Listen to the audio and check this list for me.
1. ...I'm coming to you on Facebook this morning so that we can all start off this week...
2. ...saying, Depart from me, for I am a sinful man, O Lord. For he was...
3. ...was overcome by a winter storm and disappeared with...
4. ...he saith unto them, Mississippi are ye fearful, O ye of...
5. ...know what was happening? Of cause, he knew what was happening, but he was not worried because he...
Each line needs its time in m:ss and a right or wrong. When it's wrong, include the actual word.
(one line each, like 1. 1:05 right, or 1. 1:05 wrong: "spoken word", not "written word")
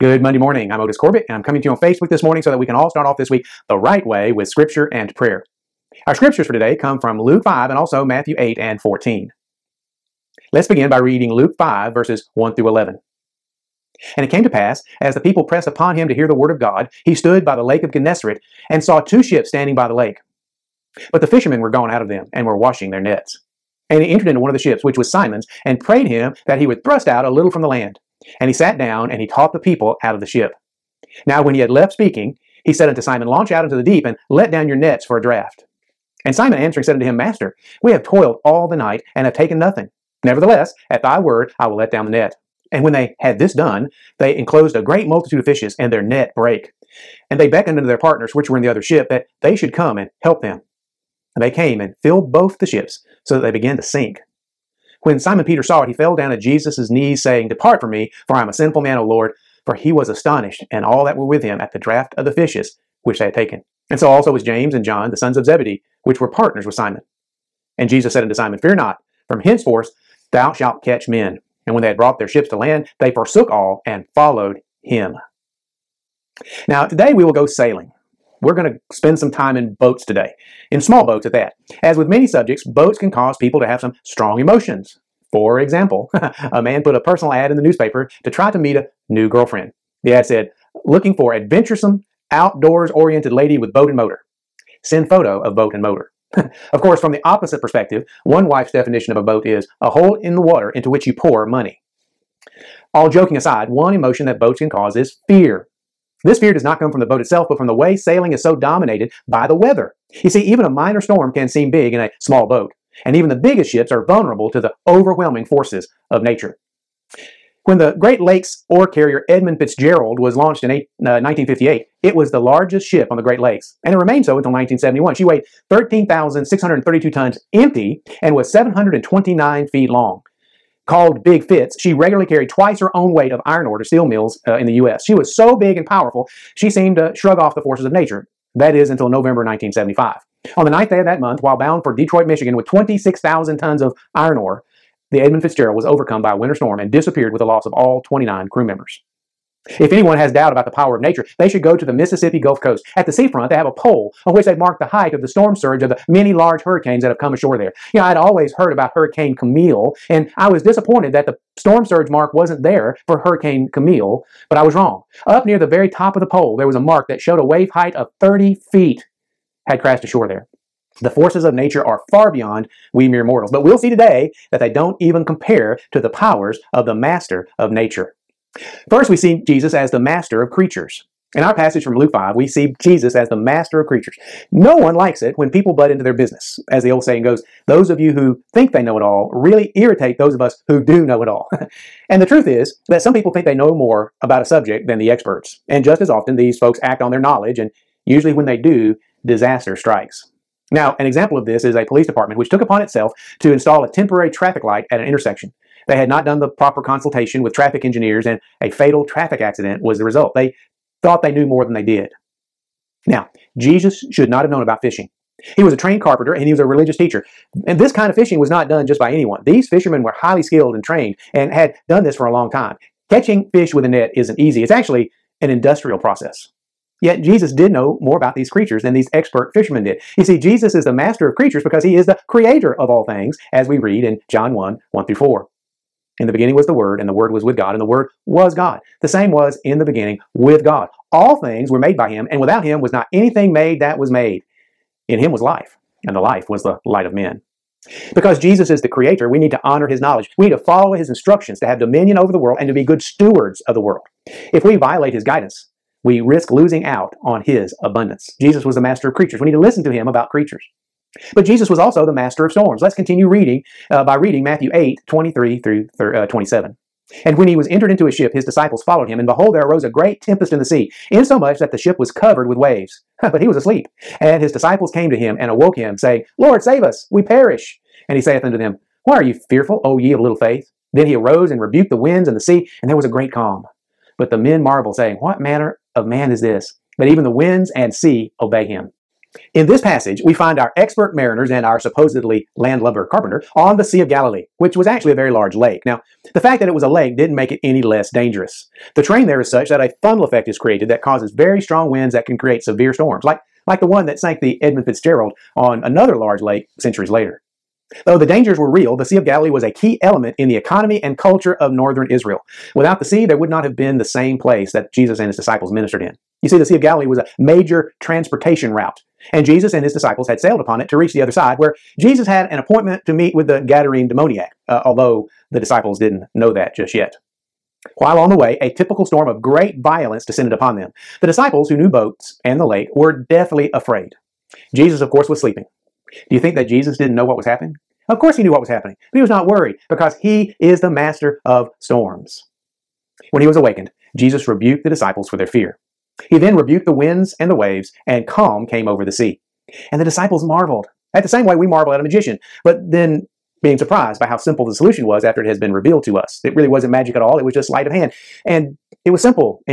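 1. 0:01 right
2. 0:57 right
3. 2:25 right
4. 4:38 wrong: "Why", not "Mississippi"
5. 5:37 wrong: "course", not "cause".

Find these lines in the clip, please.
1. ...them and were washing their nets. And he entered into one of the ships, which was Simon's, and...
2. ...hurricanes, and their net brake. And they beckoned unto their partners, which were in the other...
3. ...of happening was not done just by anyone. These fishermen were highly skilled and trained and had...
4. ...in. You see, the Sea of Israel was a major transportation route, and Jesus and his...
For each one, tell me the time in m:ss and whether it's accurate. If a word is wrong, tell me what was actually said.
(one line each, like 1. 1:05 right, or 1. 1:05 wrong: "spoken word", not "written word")
1. 0:22 right
2. 0:45 wrong: "fishes", not "hurricanes"
3. 3:38 wrong: "fishing", not "happening"
4. 5:16 wrong: "Galilee", not "Israel".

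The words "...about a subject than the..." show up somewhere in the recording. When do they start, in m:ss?
3:14.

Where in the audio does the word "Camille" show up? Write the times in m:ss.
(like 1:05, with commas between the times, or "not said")
2:39, 2:43.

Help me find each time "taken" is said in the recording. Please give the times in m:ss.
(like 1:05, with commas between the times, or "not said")
0:39, 1:03.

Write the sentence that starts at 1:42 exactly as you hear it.
All joking aside, one emotion that boats can cause is fear.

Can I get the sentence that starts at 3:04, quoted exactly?
No one likes it when people butt into their business.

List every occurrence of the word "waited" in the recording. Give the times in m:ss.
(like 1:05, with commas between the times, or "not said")
not said.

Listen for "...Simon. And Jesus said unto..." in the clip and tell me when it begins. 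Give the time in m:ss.
1:06.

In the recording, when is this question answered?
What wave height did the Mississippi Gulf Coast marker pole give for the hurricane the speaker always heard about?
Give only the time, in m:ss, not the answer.
2:48.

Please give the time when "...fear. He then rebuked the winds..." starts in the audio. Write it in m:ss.
5:45.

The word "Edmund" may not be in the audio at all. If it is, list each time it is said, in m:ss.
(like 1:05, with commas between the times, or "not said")
1:59, 2:25, 5:04.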